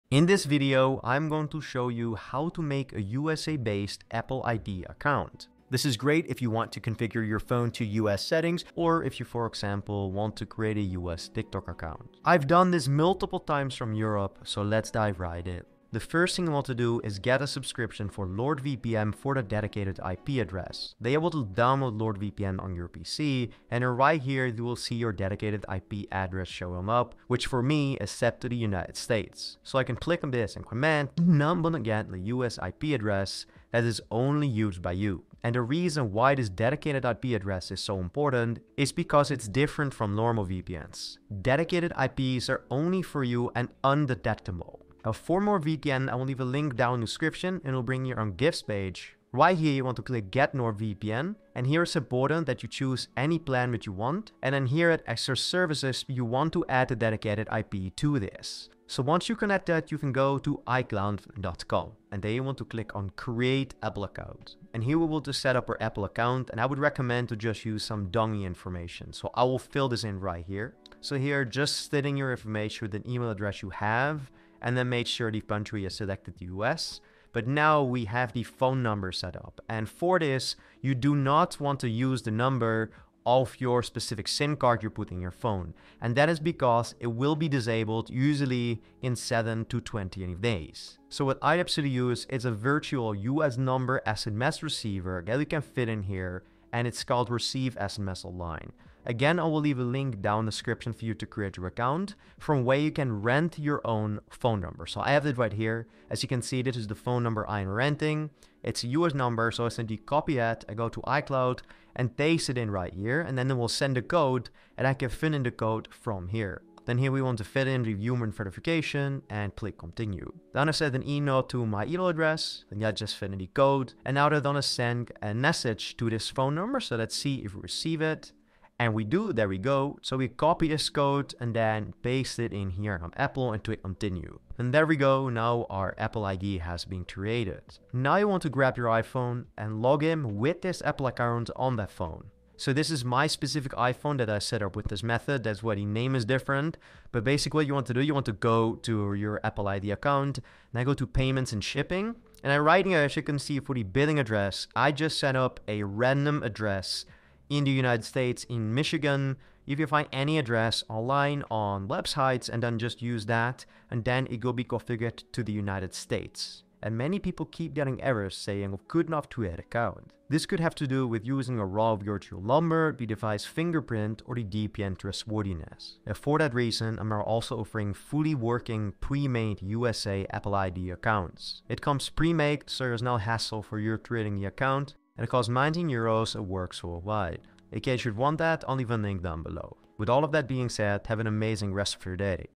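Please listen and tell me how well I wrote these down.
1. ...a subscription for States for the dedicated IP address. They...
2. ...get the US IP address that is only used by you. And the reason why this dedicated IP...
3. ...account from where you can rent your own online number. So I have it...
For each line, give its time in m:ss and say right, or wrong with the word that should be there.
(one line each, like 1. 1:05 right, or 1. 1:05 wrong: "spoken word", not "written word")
1. 0:17 wrong: "NordVPN", not "States"
2. 0:31 right
3. 1:41 wrong: "phone", not "online".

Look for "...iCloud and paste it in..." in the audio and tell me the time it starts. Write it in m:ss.
1:51.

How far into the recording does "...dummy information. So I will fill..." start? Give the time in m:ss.
1:08.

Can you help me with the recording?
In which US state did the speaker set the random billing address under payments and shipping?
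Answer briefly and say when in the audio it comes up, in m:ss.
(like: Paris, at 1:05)
Michigan, at 2:38.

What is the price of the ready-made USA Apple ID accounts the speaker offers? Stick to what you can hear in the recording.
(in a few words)
19 euros.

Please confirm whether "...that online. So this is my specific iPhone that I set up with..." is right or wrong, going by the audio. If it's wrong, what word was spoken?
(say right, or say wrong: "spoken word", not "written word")
wrong: "phone", not "online".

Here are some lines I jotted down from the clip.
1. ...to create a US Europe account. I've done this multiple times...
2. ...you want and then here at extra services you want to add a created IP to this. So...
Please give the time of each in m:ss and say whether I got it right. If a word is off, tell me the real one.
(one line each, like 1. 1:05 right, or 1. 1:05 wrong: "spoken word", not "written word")
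1. 0:10 wrong: "TikTok", not "Europe"
2. 0:53 wrong: "dedicated", not "created".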